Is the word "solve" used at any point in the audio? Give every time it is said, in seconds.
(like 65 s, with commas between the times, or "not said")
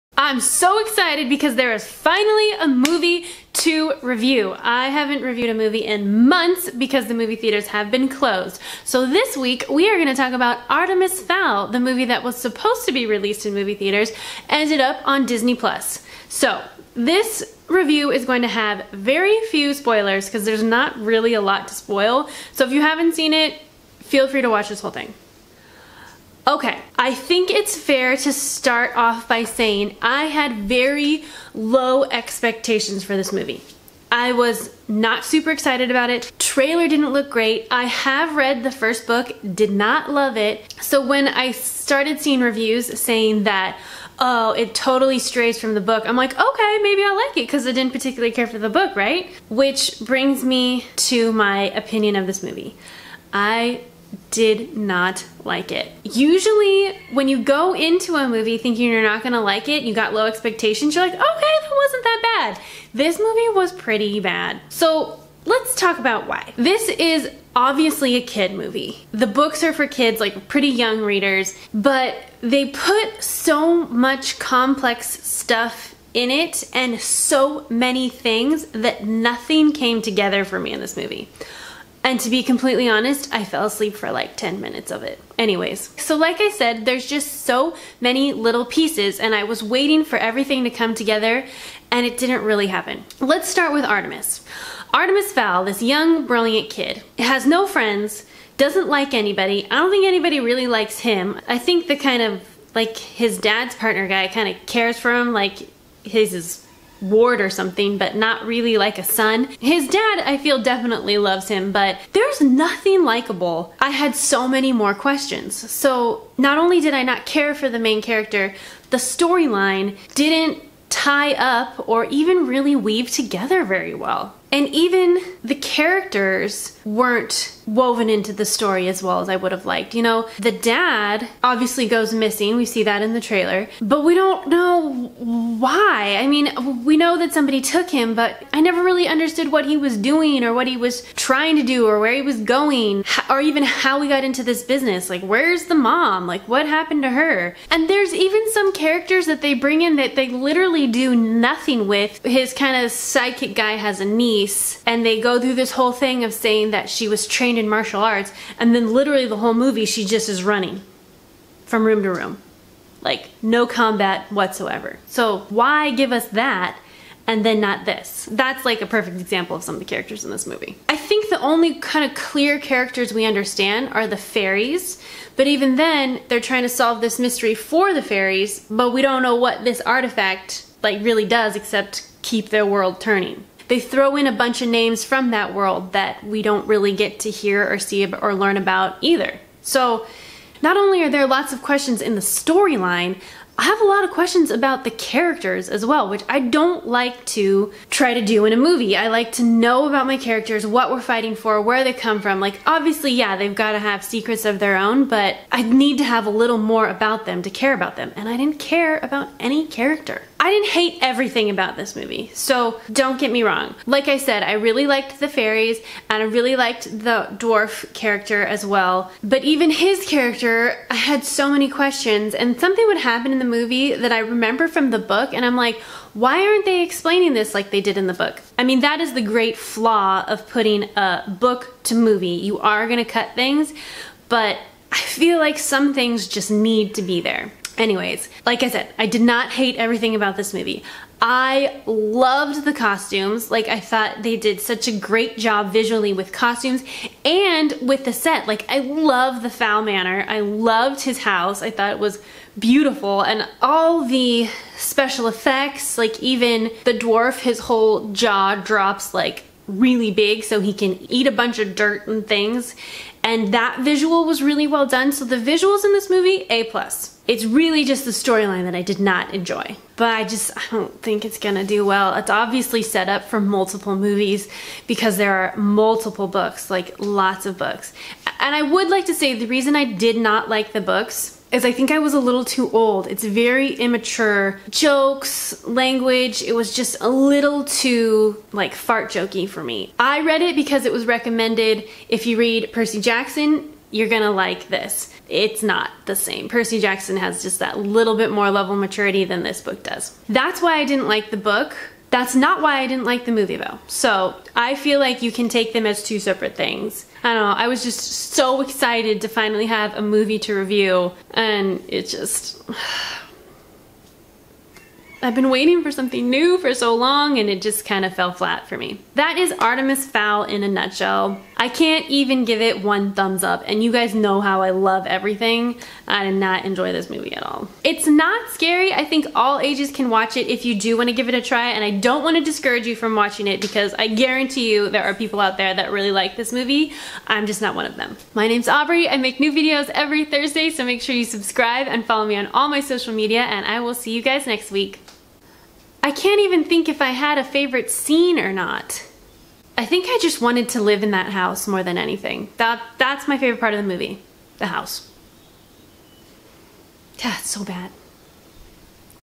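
176 s.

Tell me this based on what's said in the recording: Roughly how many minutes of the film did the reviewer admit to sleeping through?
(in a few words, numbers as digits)
10.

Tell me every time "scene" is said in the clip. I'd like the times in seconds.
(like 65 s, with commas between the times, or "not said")
347 s.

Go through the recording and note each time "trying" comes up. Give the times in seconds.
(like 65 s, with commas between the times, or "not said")
141 s, 176 s.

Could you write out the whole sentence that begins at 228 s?
I mean, that is the great flaw of putting a book to movie.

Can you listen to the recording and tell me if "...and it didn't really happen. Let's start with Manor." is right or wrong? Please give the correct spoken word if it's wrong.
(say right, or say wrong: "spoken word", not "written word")
wrong: "Artemis", not "Manor".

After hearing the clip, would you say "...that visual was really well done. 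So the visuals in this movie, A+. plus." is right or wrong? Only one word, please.
right.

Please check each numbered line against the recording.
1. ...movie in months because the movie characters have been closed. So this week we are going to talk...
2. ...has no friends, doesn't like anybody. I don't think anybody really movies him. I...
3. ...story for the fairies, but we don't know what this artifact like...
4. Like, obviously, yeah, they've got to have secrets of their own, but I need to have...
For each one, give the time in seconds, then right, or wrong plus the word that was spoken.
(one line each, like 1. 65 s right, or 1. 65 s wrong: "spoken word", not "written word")
1. 5 s wrong: "theaters", not "characters"
2. 97 s wrong: "likes", not "movies"
3. 177 s wrong: "mystery", not "story"
4. 202 s right.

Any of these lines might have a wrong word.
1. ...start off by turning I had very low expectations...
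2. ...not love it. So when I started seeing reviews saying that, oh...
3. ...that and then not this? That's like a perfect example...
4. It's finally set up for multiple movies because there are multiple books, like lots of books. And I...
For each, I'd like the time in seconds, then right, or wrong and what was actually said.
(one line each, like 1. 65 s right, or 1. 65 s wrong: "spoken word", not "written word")
1. 28 s wrong: "saying", not "turning"
2. 39 s right
3. 166 s right
4. 272 s wrong: "obviously", not "finally".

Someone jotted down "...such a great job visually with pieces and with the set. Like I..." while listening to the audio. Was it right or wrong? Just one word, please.
wrong.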